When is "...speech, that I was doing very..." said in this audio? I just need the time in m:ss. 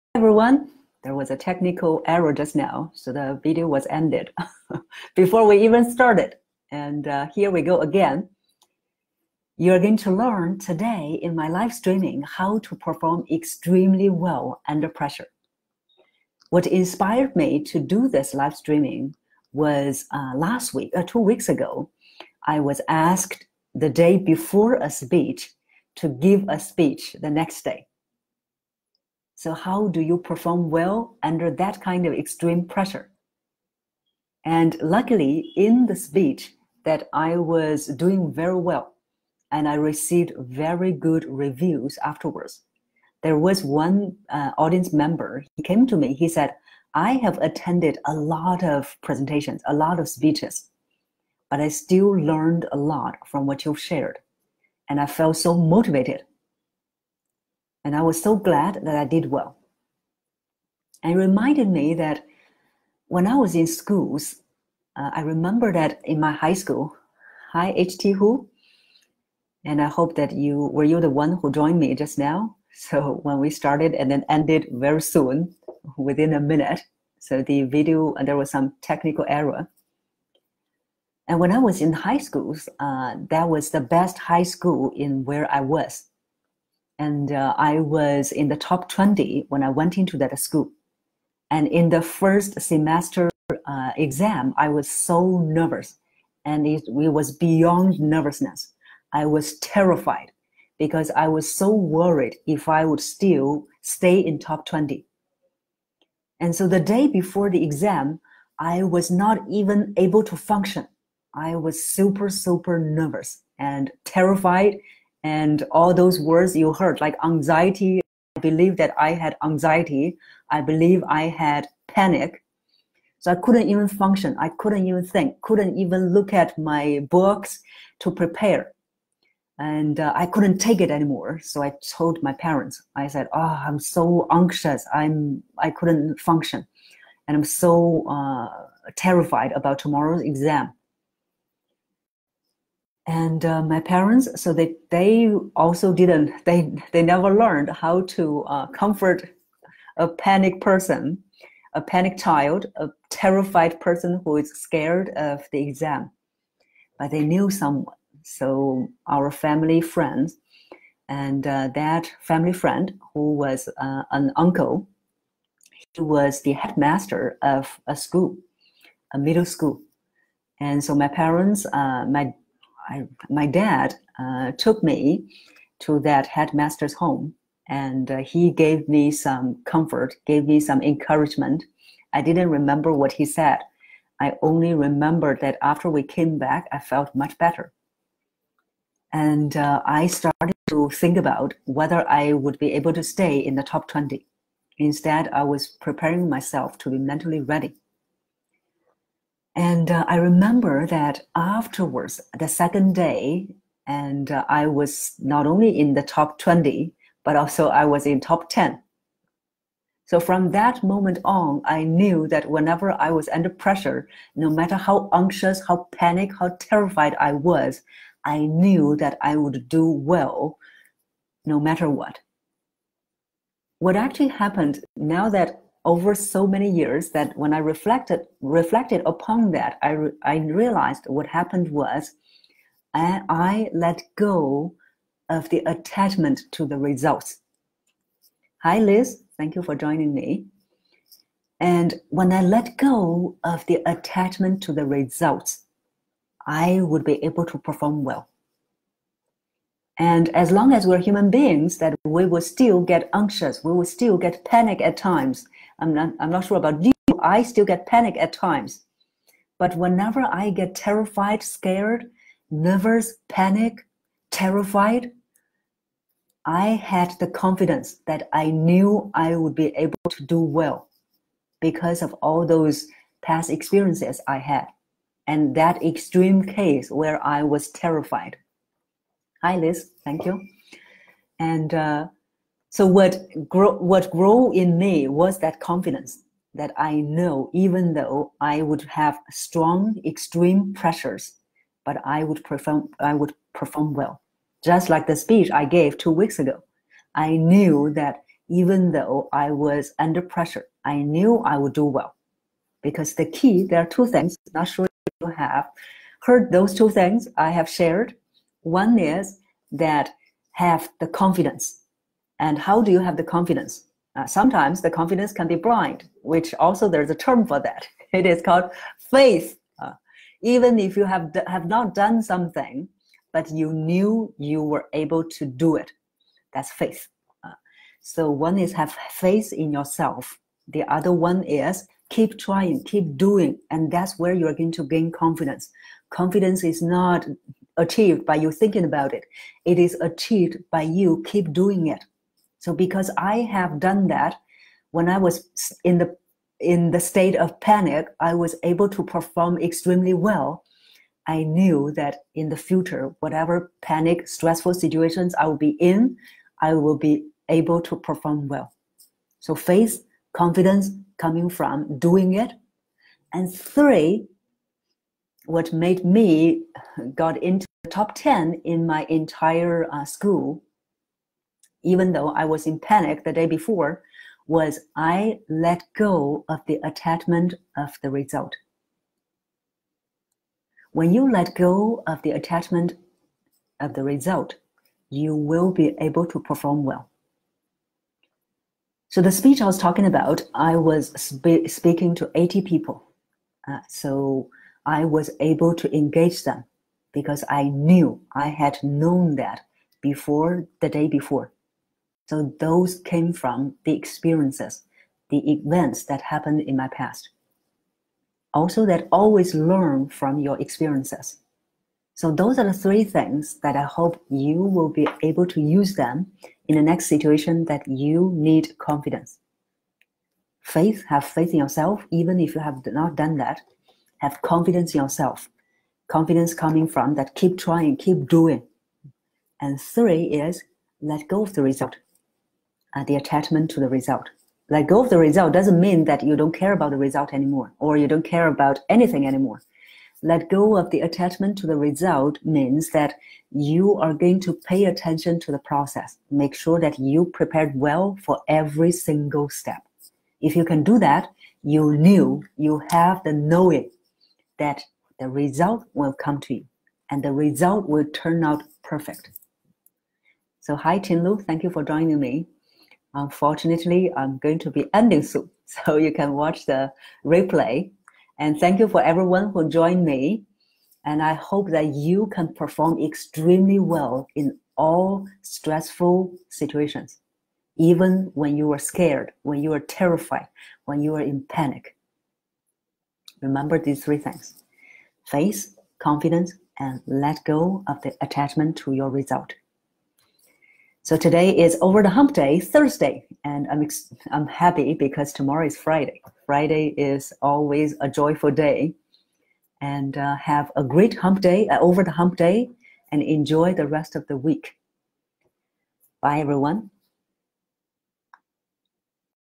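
0:35.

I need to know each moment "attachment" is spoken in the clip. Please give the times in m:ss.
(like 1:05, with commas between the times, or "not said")
3:55, 4:03, 6:16, 6:22, 7:13, 7:21, 8:08.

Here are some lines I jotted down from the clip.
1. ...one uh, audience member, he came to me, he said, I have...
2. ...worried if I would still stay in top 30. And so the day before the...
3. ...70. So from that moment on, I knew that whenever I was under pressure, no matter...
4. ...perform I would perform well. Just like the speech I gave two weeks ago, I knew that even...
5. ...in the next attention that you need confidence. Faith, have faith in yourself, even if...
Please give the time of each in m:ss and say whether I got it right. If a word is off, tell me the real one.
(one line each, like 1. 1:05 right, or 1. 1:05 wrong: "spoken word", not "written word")
1. 0:43 right
2. 1:41 wrong: "20", not "30"
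3. 3:28 wrong: "10", not "70"
4. 4:52 right
5. 6:56 wrong: "situation", not "attention".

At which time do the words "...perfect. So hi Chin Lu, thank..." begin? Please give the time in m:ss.
7:38.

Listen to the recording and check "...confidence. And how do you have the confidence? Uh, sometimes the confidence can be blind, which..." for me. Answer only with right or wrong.
right.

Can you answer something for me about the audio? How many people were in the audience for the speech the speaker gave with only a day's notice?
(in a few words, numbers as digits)
80.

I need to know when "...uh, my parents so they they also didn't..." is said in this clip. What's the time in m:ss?
2:23.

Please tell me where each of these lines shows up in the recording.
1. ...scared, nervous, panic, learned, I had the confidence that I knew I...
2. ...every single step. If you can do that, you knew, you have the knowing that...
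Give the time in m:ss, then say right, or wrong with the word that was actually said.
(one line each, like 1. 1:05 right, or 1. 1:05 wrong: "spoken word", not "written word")
1. 4:21 wrong: "terrified", not "learned"
2. 7:28 right.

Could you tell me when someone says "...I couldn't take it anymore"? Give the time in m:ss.
2:10.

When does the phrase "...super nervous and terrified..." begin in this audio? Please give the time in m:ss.
1:52.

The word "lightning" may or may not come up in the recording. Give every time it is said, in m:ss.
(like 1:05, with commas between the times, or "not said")
not said.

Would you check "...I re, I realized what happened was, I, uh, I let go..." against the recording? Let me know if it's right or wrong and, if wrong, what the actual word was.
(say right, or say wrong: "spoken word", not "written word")
right.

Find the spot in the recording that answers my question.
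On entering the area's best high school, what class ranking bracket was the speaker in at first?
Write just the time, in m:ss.
1:27.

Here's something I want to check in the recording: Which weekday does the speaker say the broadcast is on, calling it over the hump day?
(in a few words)
Thursday.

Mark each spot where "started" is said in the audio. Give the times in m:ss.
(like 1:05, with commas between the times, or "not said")
0:05, 1:13, 3:10.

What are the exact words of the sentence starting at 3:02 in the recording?
I didn't remember what he said.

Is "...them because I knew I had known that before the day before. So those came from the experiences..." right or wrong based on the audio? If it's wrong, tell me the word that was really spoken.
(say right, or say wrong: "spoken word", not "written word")
right.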